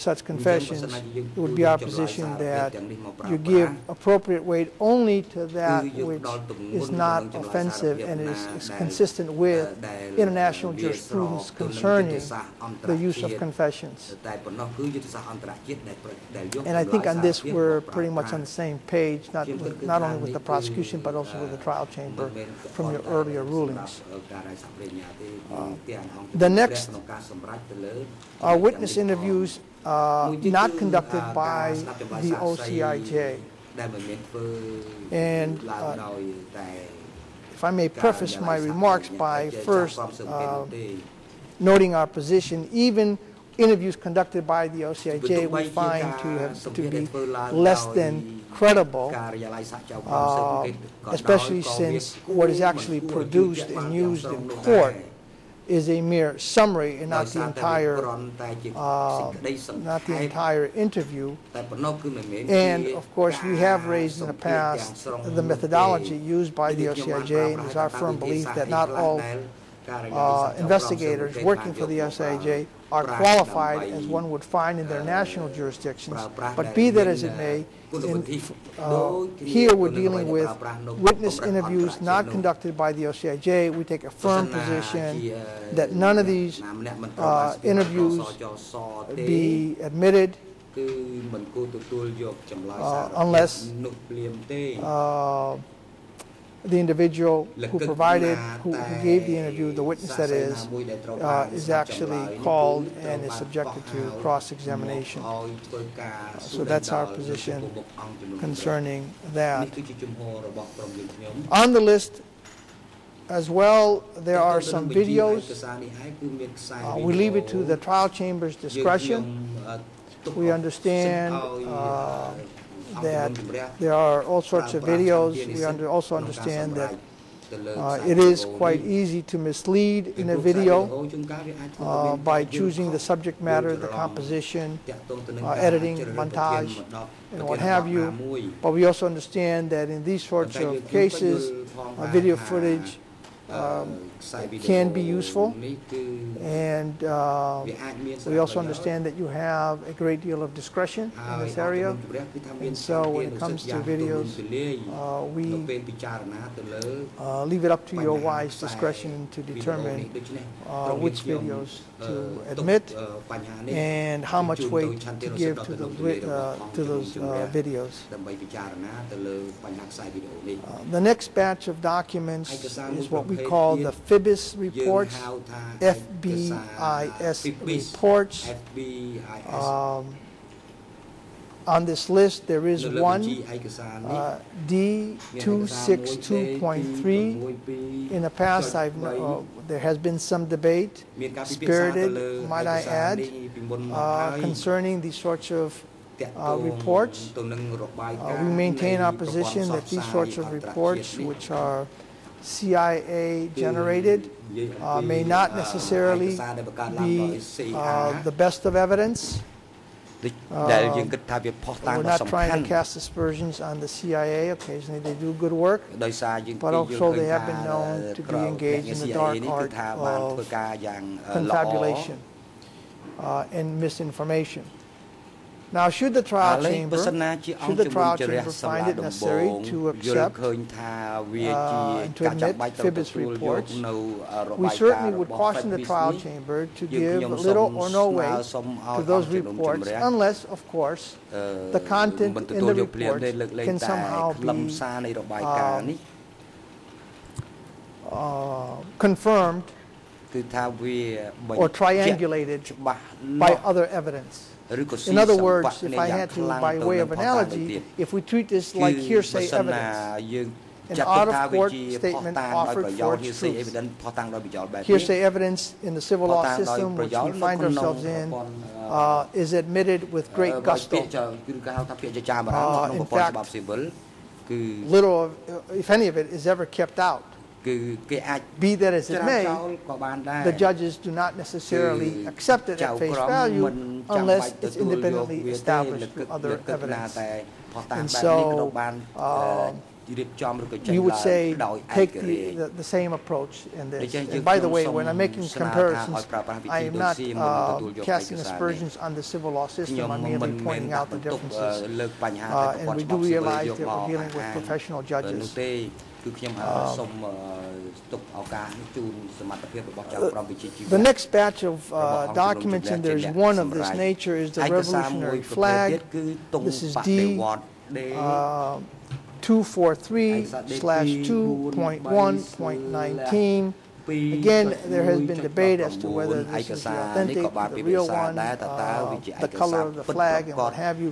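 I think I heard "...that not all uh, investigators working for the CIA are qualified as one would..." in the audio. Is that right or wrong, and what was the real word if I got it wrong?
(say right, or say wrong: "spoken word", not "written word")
wrong: "SIJ", not "CIA".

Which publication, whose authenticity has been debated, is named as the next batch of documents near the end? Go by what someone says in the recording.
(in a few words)
Revolutionary Flag.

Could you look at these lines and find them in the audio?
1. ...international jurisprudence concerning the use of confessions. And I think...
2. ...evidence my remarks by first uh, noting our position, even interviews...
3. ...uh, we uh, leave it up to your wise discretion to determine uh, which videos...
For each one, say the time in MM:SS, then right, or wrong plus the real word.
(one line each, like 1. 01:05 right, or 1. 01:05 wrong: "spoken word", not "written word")
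1. 00:10 right
2. 00:37 wrong: "preface", not "evidence"
3. 02:34 right.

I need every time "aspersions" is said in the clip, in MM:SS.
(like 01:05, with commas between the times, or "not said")
03:32, 04:58.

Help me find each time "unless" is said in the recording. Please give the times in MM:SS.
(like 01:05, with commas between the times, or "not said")
01:33, 03:59, 04:44.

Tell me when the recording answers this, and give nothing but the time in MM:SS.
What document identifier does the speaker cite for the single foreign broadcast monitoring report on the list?
03:04.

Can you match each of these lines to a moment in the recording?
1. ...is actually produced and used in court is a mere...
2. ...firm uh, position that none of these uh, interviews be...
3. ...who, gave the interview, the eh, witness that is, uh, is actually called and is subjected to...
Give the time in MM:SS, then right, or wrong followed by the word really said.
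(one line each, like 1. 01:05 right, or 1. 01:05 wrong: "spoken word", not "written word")
1. 00:52 right
2. 01:24 right
3. 01:38 right.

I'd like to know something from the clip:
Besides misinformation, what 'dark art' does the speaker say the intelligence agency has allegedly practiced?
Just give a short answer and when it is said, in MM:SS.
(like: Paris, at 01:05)
confabulation, at 03:41.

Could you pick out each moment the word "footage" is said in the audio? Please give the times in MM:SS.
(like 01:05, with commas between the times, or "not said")
02:22.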